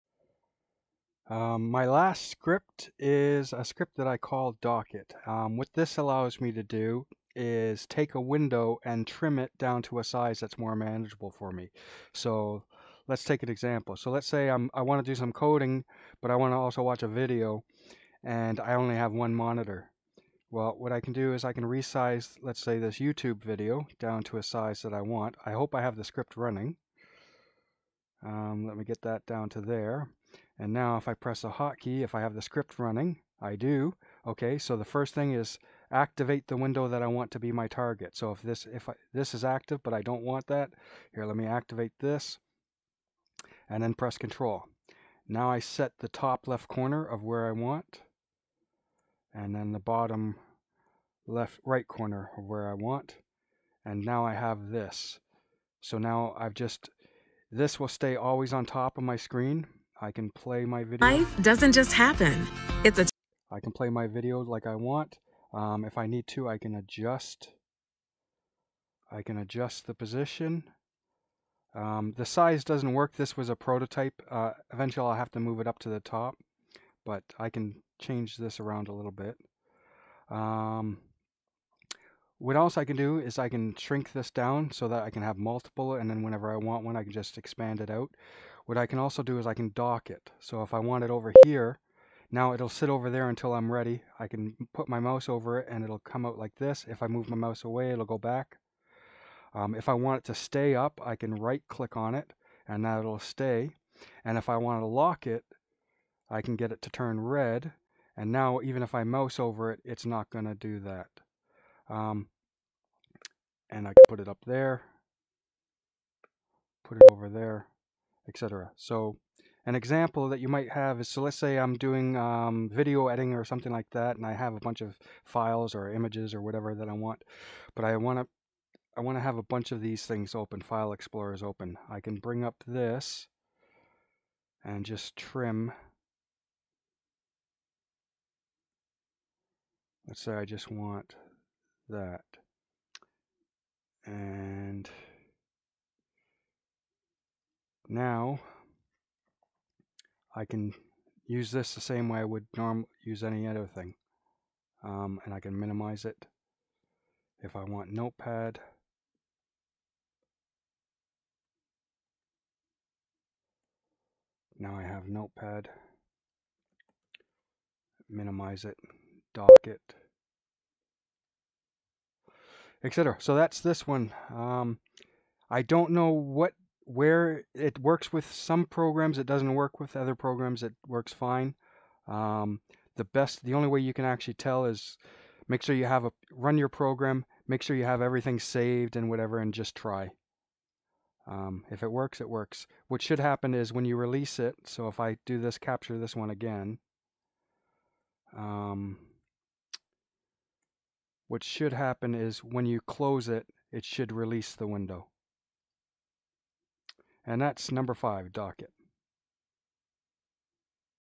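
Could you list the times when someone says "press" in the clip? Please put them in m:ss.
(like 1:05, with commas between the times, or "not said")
0:31, 0:43.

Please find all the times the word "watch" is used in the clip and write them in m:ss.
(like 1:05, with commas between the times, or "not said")
0:16.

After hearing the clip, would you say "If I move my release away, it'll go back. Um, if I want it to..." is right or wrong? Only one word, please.
wrong.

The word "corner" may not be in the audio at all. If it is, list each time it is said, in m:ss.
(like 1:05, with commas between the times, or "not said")
0:46, 0:51.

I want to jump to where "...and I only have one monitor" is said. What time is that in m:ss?
0:18.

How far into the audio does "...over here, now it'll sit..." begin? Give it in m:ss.
1:31.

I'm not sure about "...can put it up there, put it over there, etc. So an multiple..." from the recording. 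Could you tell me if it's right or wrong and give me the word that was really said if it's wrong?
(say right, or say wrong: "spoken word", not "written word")
wrong: "example", not "multiple".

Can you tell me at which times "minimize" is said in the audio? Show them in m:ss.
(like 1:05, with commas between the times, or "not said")
2:35, 2:48.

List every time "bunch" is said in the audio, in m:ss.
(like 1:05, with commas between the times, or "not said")
2:04, 2:09.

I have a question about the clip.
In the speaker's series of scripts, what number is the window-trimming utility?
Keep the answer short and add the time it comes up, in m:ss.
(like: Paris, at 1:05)
5, at 3:27.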